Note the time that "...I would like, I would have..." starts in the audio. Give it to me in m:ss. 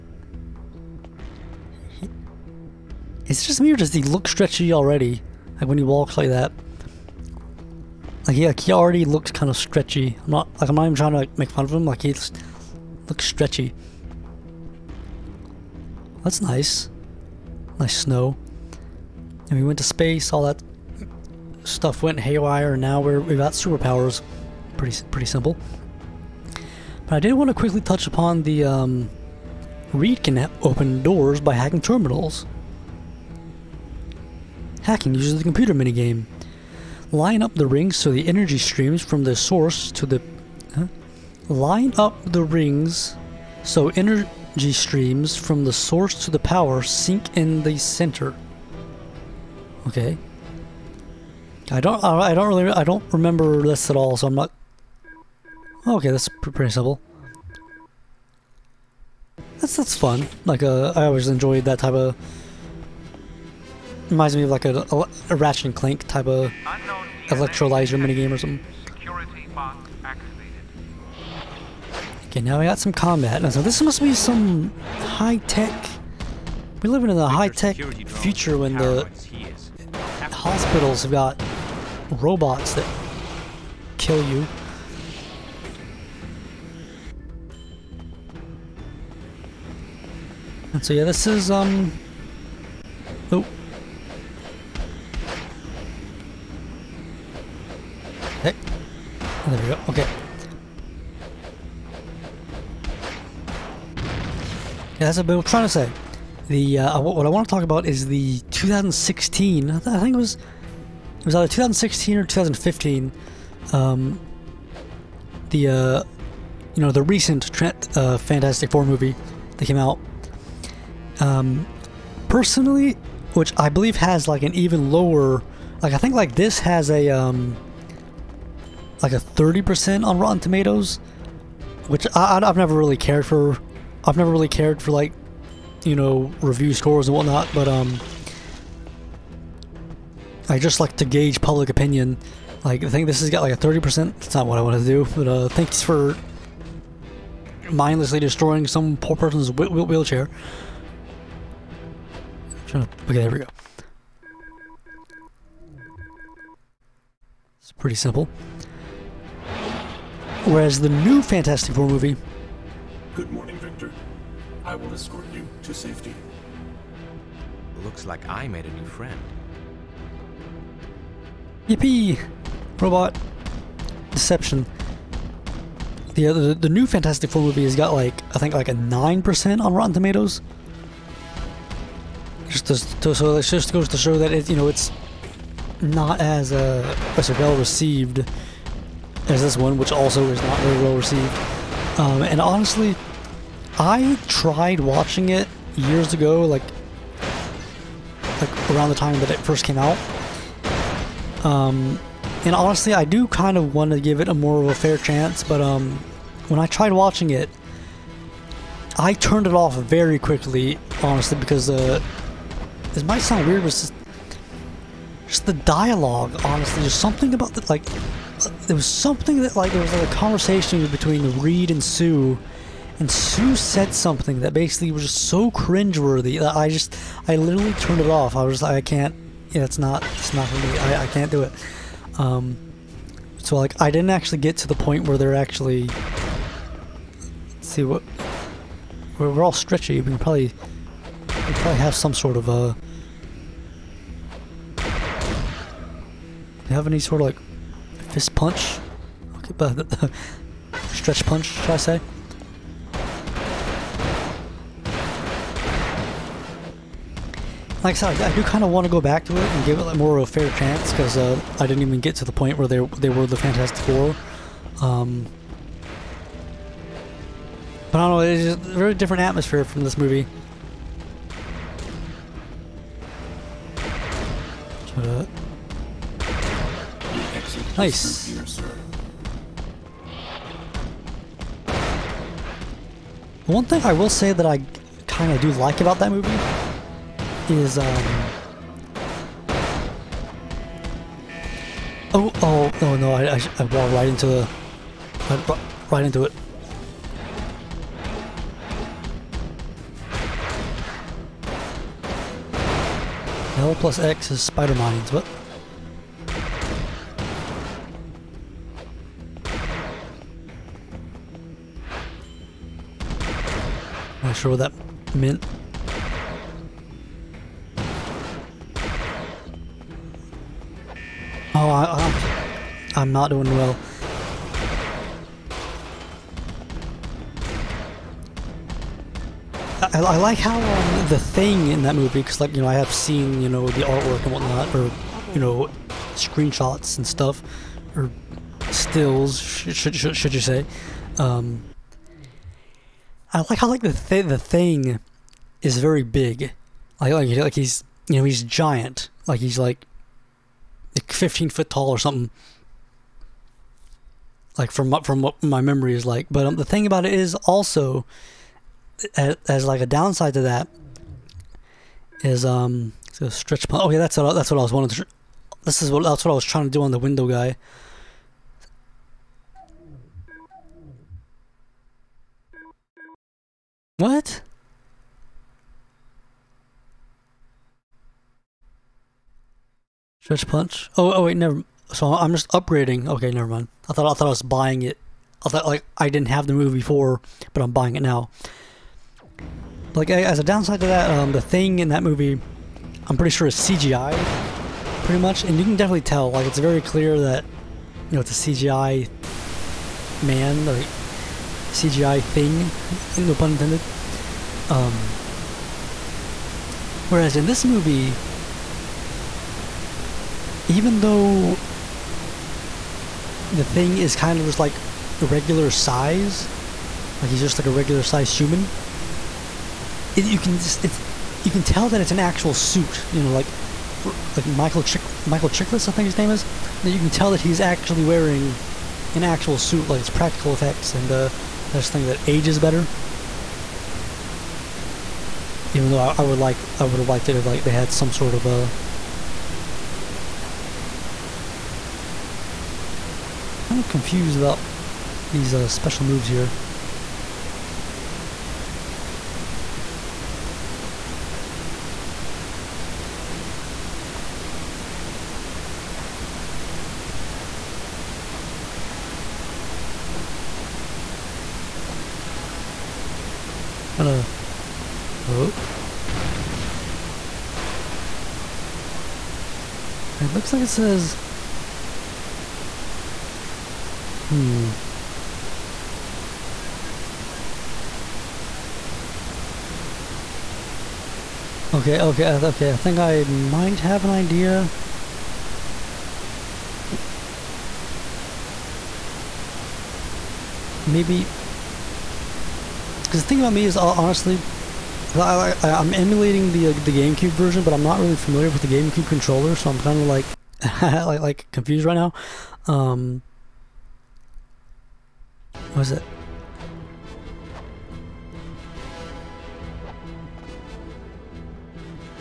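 7:16.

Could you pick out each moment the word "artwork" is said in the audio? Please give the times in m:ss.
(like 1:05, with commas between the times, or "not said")
5:33.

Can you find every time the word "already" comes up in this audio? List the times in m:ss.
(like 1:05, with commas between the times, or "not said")
0:04, 0:08.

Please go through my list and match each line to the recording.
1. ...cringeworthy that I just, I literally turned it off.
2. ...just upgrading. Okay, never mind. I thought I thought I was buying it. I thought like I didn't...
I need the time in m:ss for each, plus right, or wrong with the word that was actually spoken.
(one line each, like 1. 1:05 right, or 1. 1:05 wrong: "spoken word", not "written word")
1. 3:45 right
2. 6:22 right.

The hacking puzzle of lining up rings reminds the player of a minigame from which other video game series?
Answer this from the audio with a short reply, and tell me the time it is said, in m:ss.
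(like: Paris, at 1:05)
Ratchet and Clank, at 1:05.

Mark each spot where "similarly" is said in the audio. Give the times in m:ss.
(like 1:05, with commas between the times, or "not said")
not said.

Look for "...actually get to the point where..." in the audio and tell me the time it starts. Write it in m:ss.
3:54.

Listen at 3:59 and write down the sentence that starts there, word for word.
We can probably we probably have some sort of a...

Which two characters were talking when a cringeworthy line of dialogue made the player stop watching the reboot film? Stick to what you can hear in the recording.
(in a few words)
Reed and Sue.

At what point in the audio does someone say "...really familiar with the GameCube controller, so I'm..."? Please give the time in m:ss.
8:17.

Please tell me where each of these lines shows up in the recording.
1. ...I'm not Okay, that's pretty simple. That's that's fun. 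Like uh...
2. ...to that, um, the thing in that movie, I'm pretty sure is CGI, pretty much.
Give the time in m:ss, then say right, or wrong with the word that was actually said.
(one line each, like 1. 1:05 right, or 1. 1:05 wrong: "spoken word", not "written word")
1. 0:54 right
2. 6:30 right.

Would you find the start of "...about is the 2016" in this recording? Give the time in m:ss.
1:47.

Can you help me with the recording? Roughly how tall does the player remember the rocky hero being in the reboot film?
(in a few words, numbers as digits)
15 feet.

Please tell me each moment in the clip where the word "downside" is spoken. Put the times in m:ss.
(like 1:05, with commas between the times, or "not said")
5:59, 6:30.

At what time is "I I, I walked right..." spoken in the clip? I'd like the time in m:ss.
4:53.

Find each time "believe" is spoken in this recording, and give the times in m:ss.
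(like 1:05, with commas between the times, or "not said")
2:03.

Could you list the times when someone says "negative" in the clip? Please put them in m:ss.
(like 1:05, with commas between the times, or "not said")
not said.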